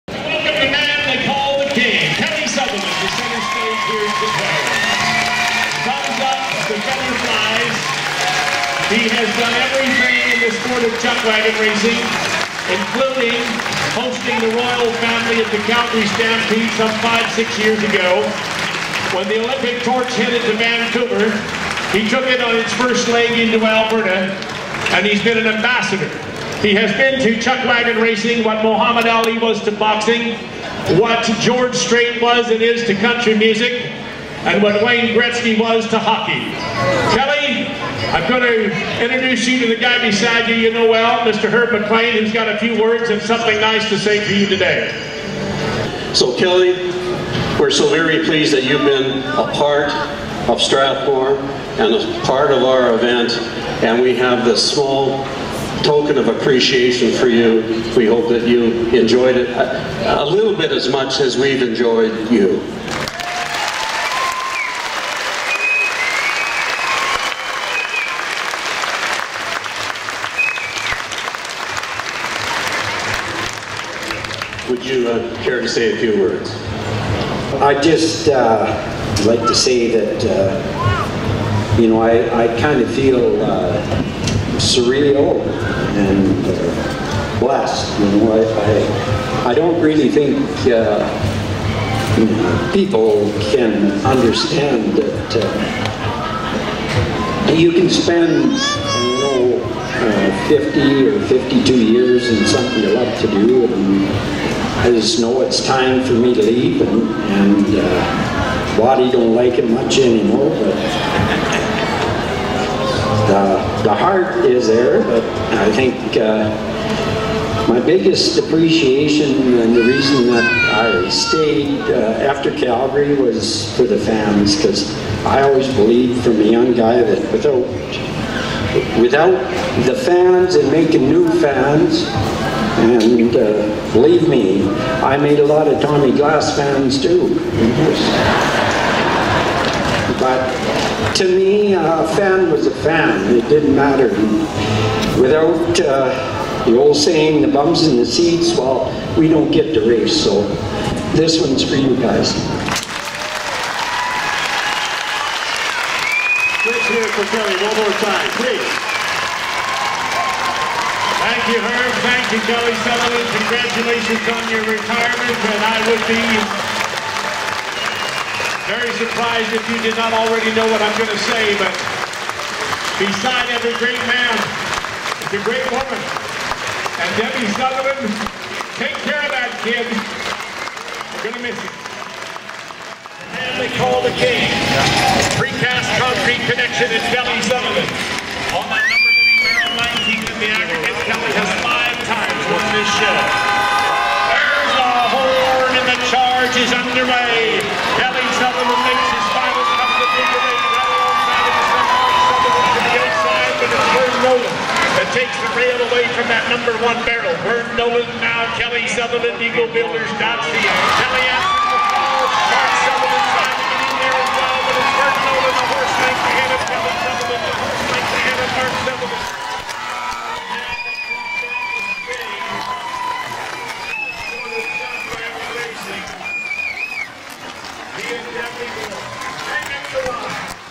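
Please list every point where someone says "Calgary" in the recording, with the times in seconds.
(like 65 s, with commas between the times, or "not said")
15 s, 122 s.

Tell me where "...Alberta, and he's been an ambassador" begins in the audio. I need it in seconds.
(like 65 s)
23 s.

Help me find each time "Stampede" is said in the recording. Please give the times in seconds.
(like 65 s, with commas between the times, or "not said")
16 s.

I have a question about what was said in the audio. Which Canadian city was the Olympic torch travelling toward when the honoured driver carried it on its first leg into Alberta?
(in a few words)
Vancouver.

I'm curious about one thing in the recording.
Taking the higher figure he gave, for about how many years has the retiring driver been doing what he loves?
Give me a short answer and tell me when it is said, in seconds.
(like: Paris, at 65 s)
52, at 101 s.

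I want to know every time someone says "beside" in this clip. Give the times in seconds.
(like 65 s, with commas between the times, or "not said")
40 s, 172 s.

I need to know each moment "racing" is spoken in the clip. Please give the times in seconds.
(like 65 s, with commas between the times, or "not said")
11 s, 28 s.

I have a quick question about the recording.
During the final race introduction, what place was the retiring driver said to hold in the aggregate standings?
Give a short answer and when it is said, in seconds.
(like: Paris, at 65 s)
19th, at 189 s.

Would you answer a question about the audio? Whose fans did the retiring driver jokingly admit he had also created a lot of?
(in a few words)
Tommy Glass.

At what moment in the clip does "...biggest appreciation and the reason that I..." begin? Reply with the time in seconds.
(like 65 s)
117 s.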